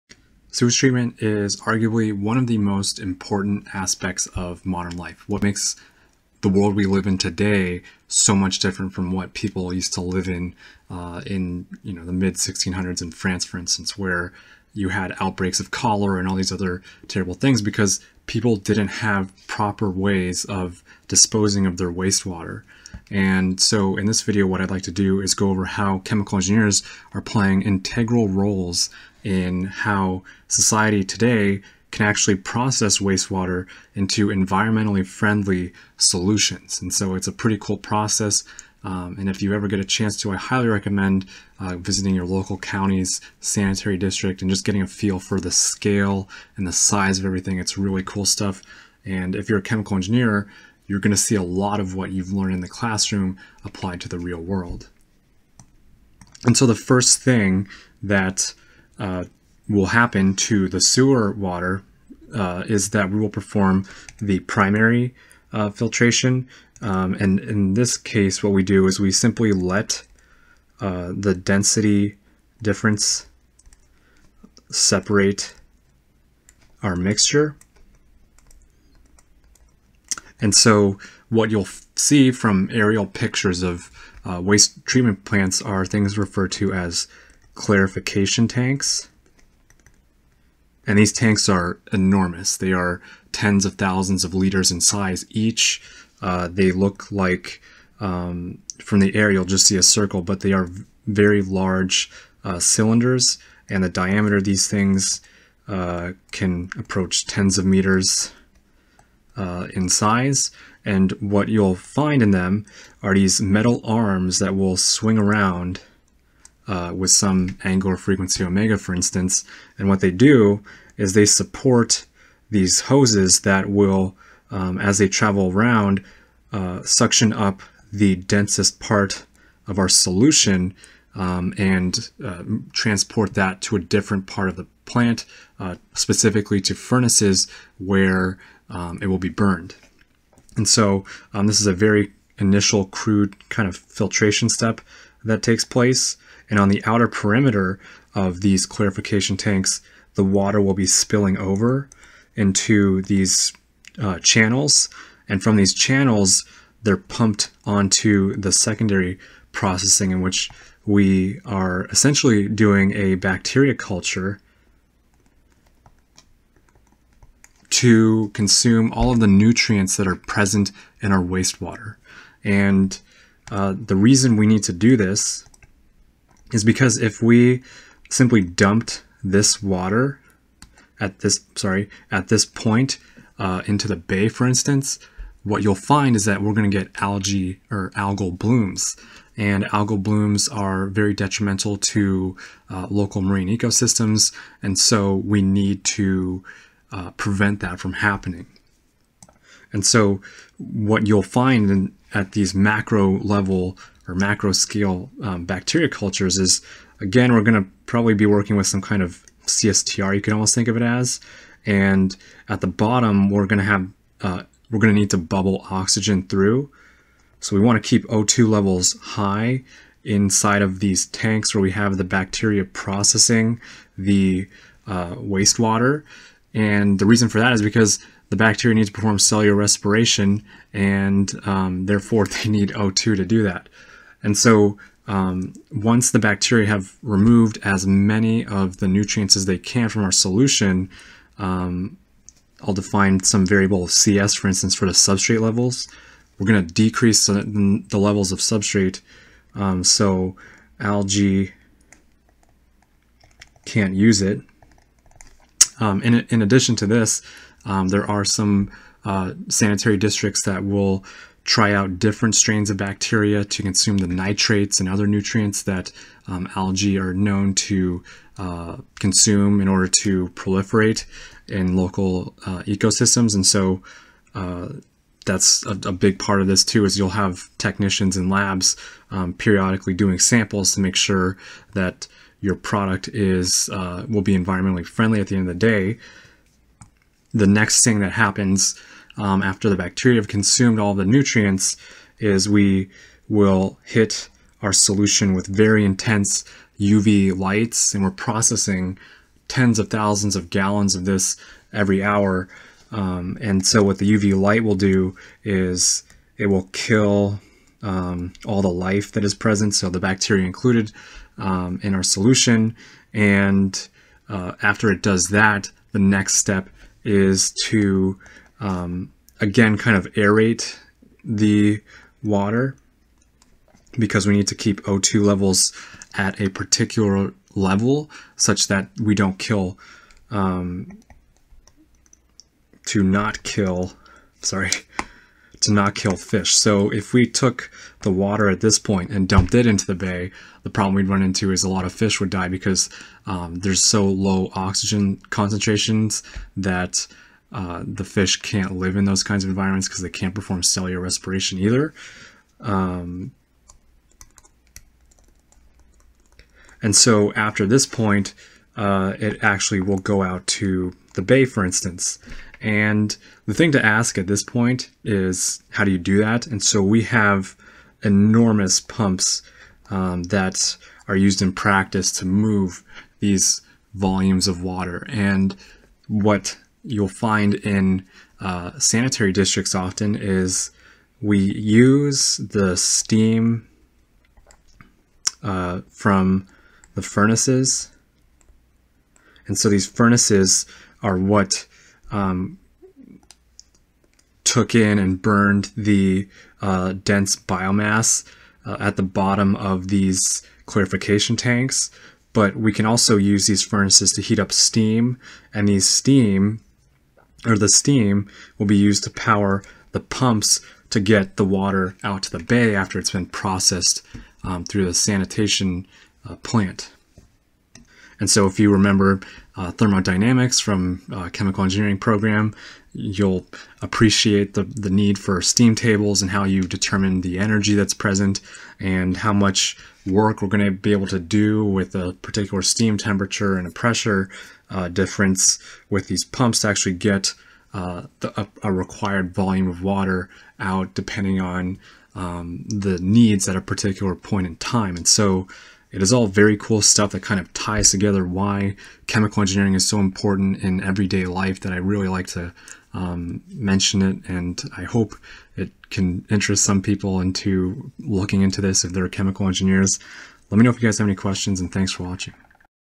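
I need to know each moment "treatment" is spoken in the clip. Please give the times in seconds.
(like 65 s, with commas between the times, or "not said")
0 s, 84 s.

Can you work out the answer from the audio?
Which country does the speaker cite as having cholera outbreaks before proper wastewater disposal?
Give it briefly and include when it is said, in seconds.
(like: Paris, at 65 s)
France, at 13 s.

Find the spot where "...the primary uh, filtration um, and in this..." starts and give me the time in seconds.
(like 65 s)
64 s.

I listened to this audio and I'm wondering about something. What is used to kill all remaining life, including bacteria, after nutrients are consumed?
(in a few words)
UV lights.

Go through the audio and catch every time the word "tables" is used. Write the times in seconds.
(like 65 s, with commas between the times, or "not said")
425 s.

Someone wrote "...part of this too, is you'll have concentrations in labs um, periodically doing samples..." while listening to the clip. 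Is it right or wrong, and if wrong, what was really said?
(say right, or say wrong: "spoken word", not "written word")
wrong: "technicians", not "concentrations".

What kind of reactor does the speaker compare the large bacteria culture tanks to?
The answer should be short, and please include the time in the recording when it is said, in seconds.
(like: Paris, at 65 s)
CSTR, at 209 s.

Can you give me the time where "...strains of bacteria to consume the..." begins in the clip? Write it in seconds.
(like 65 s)
262 s.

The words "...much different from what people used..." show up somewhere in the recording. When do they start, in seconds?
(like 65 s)
8 s.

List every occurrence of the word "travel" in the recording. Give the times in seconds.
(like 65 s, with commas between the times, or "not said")
125 s.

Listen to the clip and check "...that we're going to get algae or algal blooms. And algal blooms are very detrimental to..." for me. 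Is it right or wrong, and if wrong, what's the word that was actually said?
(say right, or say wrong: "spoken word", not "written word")
right.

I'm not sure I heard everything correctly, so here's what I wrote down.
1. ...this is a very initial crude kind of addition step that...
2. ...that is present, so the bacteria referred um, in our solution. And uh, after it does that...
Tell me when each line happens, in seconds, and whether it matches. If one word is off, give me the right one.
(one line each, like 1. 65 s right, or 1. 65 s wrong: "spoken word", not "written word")
1. 141 s wrong: "filtration", not "addition"
2. 309 s wrong: "included", not "referred".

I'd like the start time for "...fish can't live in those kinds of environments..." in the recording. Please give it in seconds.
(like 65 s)
348 s.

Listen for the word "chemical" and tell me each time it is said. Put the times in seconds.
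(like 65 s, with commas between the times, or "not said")
25 s, 49 s, 421 s, 449 s, 459 s.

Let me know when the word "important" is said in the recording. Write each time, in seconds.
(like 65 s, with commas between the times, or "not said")
2 s, 449 s.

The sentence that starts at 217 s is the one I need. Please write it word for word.
So we want to keep O2 levels high inside of these tanks where we have the bacteria processing the uh, wastewater.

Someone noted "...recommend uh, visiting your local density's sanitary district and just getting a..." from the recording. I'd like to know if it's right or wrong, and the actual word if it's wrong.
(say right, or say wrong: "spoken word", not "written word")
wrong: "county", not "density".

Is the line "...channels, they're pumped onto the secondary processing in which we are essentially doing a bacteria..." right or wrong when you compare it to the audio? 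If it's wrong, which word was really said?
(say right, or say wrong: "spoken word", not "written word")
right.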